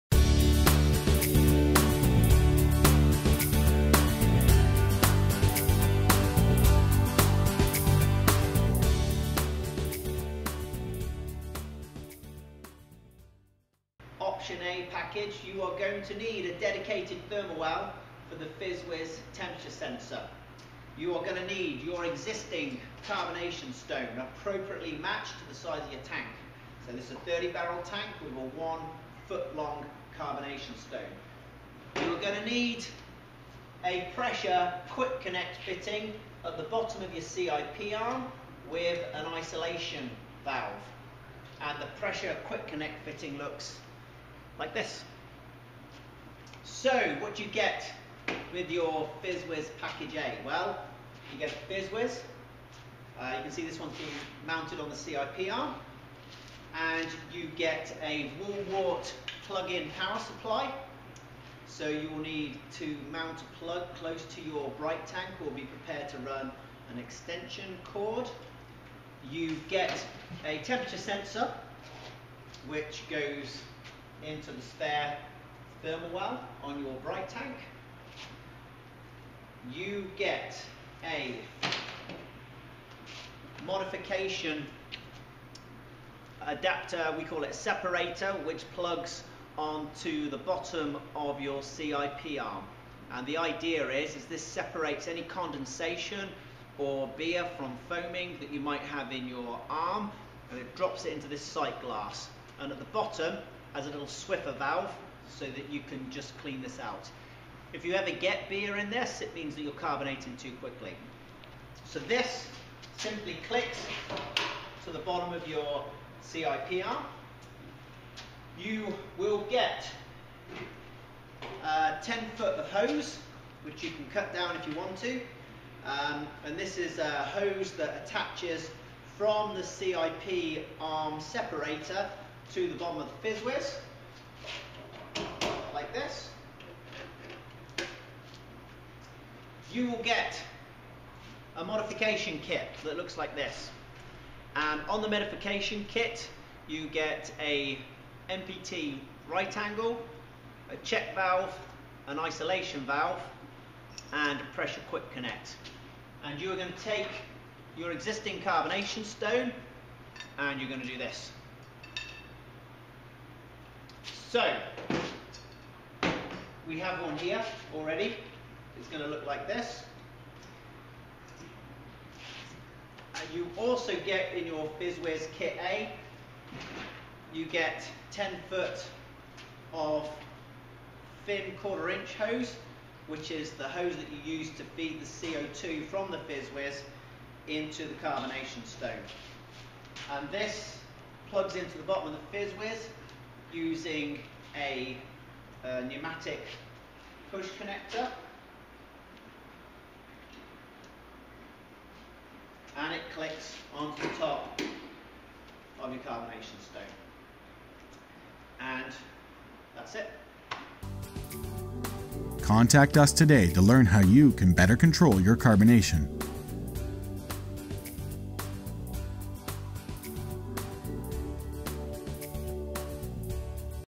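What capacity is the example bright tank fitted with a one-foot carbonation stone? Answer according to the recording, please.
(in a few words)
30 barrel.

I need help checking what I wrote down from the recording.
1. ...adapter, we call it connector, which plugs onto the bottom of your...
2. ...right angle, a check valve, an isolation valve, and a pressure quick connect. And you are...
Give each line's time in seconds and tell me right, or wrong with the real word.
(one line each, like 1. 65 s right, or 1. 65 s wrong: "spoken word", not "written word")
1. 86 s wrong: "separator", not "connector"
2. 149 s right.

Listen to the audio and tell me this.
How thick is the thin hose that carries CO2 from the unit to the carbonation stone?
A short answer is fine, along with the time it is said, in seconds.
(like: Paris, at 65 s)
quarter inch, at 181 s.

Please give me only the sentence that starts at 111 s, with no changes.
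So this simply clicks to the bottom of your CIP arm.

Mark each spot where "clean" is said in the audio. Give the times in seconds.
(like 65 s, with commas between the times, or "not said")
106 s.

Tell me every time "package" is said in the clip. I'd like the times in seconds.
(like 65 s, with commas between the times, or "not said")
14 s, 49 s.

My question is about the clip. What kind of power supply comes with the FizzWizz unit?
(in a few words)
wall wart.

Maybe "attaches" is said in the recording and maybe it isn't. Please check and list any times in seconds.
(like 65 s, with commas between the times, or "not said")
128 s.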